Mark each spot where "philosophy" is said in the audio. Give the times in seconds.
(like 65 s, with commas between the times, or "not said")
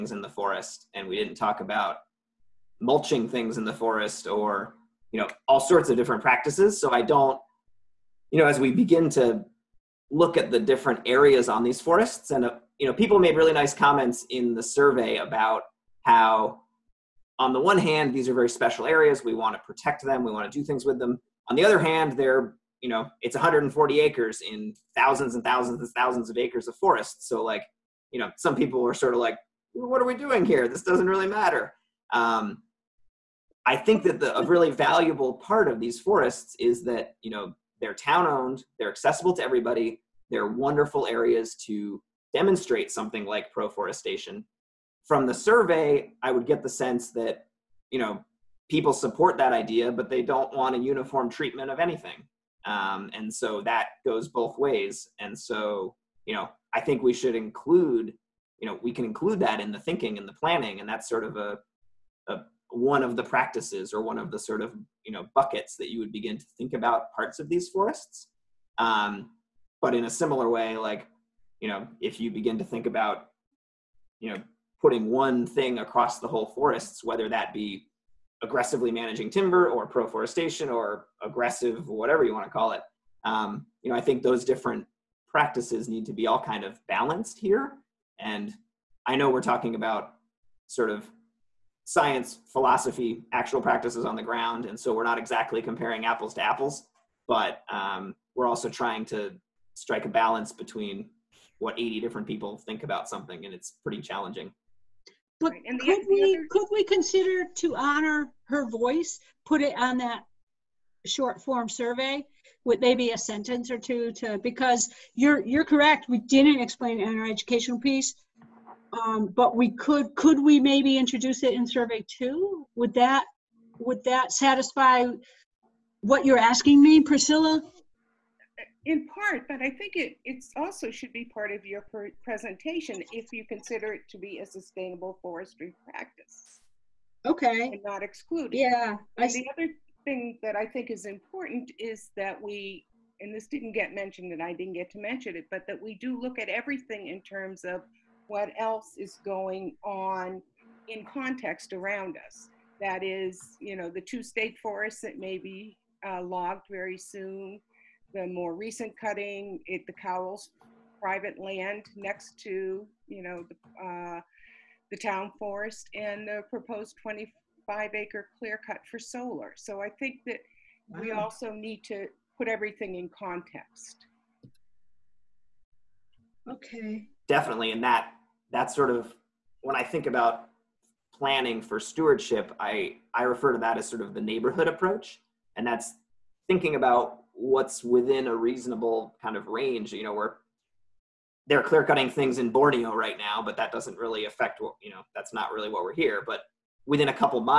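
92 s.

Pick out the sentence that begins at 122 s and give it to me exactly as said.
Would that, would that satisfy what you're asking me, Priscilla?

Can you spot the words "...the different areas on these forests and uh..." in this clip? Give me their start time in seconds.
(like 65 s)
10 s.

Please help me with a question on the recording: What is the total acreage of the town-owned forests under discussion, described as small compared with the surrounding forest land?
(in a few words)
140 acres.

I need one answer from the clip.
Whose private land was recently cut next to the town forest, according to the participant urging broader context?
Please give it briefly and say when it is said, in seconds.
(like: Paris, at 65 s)
Cowles, at 159 s.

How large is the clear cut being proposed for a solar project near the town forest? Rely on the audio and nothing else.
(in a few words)
25 acres.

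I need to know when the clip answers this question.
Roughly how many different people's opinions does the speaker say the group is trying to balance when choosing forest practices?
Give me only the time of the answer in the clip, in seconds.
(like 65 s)
101 s.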